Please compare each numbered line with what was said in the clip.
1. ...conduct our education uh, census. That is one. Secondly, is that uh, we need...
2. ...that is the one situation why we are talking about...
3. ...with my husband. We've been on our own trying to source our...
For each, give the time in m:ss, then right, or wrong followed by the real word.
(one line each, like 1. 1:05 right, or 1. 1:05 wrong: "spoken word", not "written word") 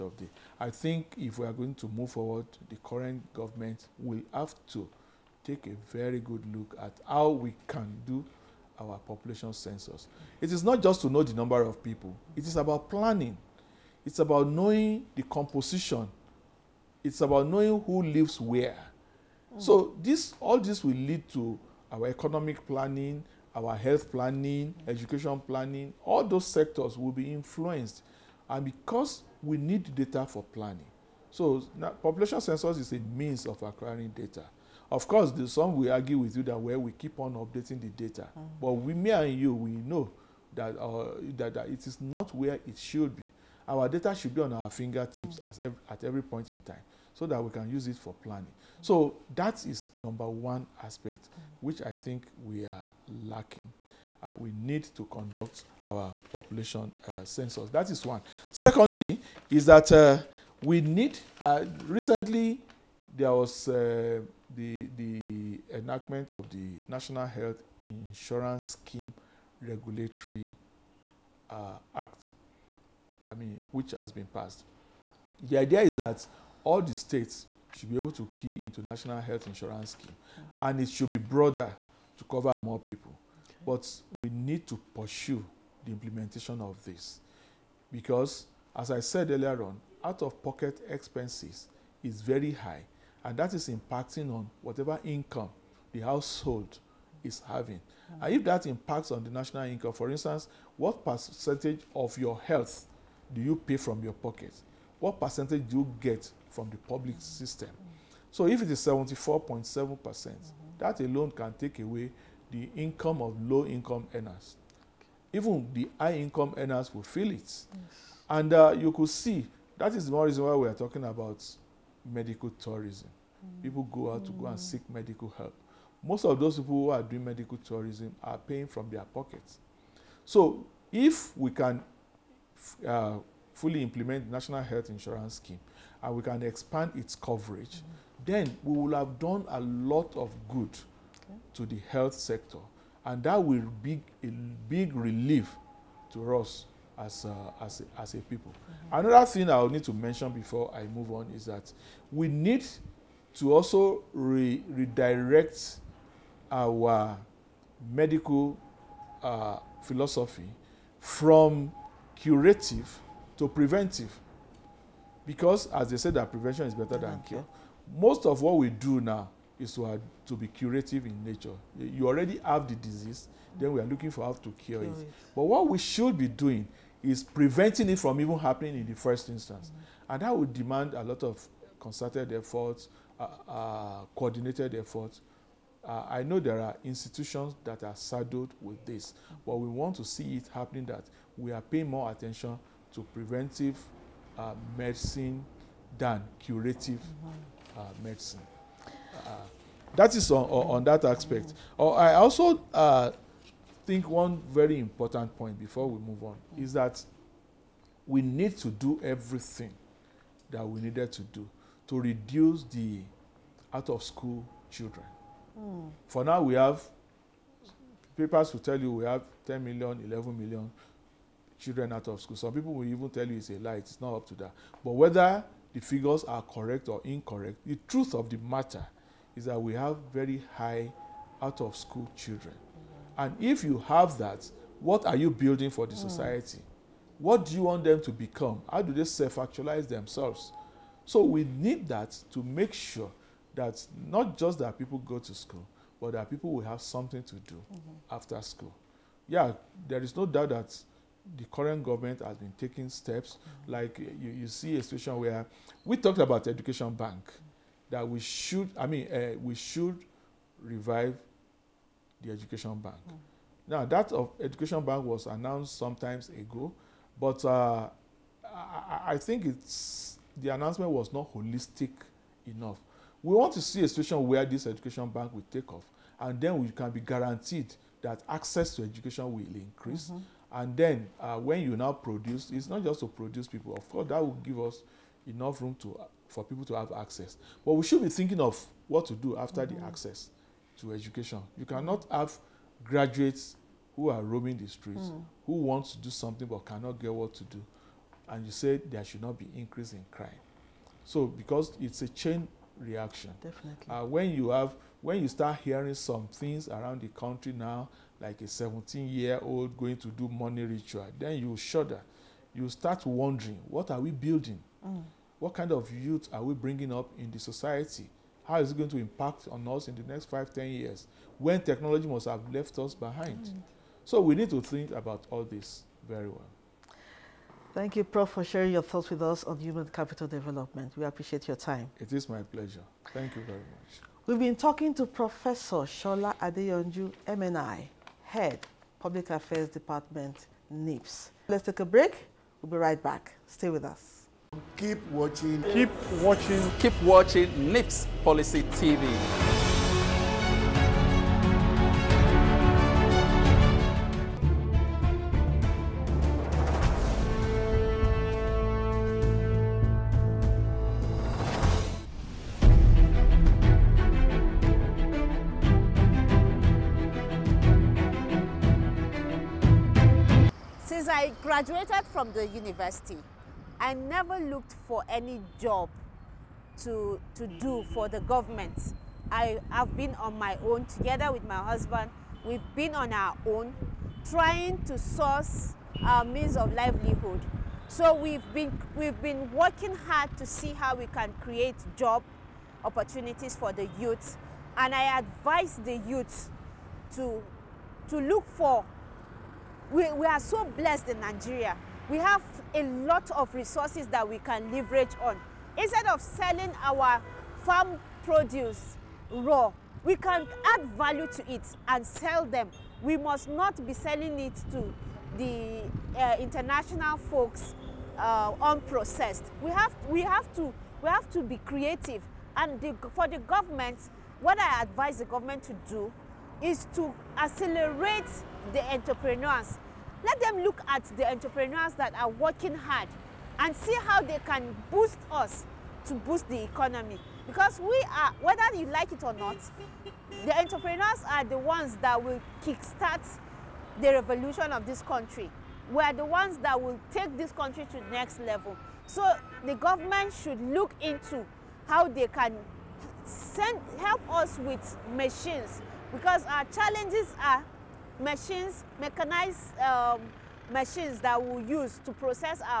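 1. 0:55 wrong: "population", not "education"
2. 1:59 wrong: "reason", not "situation"
3. 6:21 right.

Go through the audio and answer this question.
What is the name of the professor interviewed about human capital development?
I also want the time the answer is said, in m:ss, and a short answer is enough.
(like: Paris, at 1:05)
Shola Adeyonju, at 5:35.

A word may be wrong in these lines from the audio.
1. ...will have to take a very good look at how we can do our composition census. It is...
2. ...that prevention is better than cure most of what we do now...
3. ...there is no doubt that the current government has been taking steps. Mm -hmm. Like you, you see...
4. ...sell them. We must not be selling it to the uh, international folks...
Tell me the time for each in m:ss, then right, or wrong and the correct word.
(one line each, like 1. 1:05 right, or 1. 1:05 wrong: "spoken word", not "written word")
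1. 0:03 wrong: "population", not "composition"
2. 2:46 right
3. 4:09 right
4. 6:52 right.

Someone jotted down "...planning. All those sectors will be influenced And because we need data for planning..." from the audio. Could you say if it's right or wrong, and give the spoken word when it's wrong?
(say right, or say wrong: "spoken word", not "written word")
right.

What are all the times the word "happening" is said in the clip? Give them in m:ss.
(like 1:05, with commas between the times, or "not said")
2:58, 3:10.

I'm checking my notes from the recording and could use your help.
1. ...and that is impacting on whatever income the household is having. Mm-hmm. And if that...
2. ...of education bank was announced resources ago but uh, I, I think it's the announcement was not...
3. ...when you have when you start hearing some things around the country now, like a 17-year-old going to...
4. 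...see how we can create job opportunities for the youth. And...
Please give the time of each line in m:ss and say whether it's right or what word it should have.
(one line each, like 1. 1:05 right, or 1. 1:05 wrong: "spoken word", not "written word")
1. 1:33 right
2. 4:24 wrong: "sometimes", not "resources"
3. 5:04 right
4. 6:30 right.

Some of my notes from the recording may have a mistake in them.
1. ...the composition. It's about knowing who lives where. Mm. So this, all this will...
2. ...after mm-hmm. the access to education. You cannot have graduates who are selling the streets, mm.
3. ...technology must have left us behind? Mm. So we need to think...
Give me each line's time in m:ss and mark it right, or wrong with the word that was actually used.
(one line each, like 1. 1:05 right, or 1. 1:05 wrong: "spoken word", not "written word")
1. 0:15 right
2. 4:49 wrong: "roaming", not "selling"
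3. 5:21 right.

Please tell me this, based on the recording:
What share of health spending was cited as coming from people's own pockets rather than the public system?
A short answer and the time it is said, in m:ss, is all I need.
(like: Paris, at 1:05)
74.7%, at 1:48.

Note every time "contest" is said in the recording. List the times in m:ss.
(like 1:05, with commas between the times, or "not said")
not said.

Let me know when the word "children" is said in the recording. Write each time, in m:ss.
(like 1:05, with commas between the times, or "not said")
3:34, 3:41, 3:52.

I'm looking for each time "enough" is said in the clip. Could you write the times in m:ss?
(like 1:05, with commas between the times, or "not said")
4:32, 4:45.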